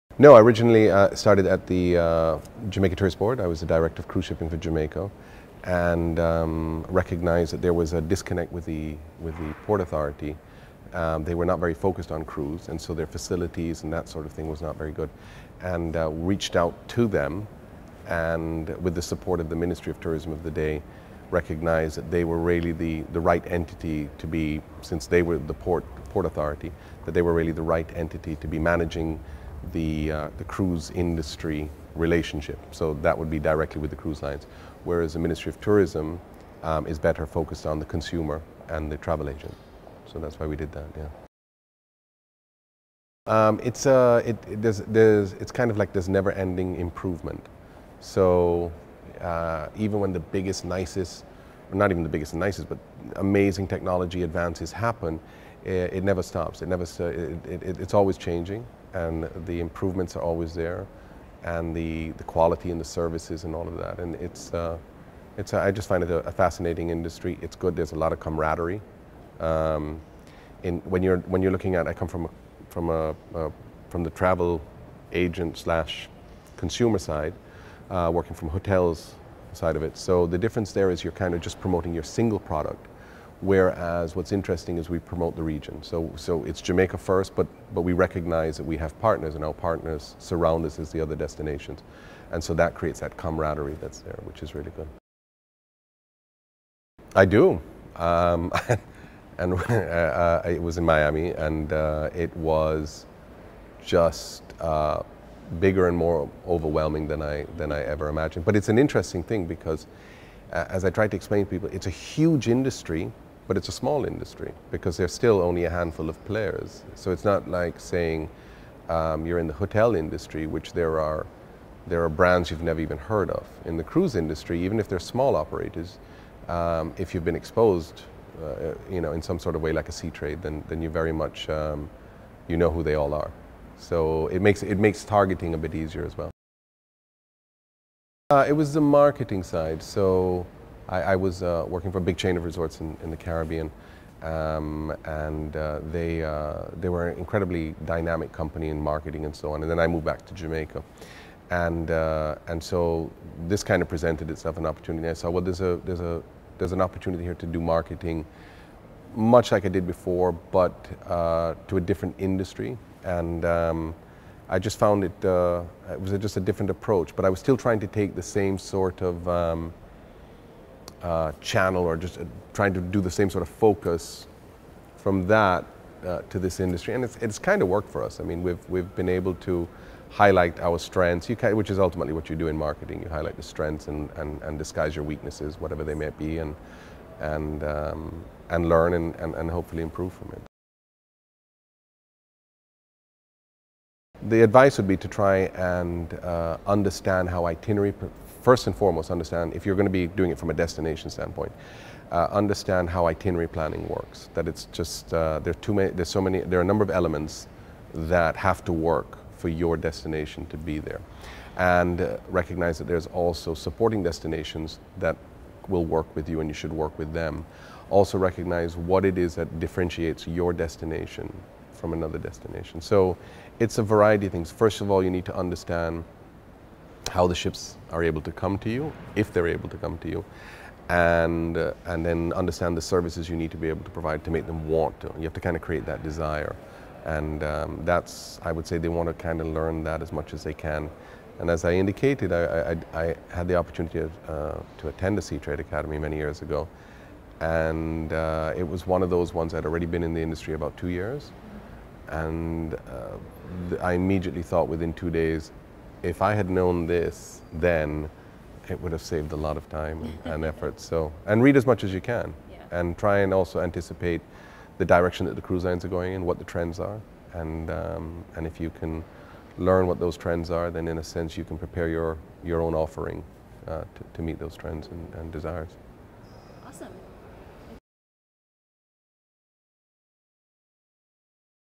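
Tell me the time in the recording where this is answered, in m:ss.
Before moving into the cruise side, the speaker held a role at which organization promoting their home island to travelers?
0:02.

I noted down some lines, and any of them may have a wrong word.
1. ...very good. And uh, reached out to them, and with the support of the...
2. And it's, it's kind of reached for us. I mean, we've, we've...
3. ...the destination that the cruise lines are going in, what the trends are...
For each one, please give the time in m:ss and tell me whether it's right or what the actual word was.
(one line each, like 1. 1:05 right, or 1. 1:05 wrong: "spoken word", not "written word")
1. 0:14 right
2. 2:56 wrong: "worked", not "reached"
3. 4:24 wrong: "direction", not "destination".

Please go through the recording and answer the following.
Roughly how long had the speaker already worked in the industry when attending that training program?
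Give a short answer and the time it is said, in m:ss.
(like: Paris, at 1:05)
about 2 years, at 4:10.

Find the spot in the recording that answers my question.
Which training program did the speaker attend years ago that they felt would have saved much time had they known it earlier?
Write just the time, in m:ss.
4:05.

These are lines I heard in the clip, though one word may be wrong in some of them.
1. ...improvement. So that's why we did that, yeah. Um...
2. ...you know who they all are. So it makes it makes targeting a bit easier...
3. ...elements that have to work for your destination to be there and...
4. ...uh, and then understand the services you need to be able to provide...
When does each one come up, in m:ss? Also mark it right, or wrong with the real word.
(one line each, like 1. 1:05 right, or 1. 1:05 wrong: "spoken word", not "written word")
1. 0:39 wrong: "agent", not "improvement"
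2. 2:12 right
3. 3:26 right
4. 3:51 right.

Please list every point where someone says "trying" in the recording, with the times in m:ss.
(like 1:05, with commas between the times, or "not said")
2:47, 2:52.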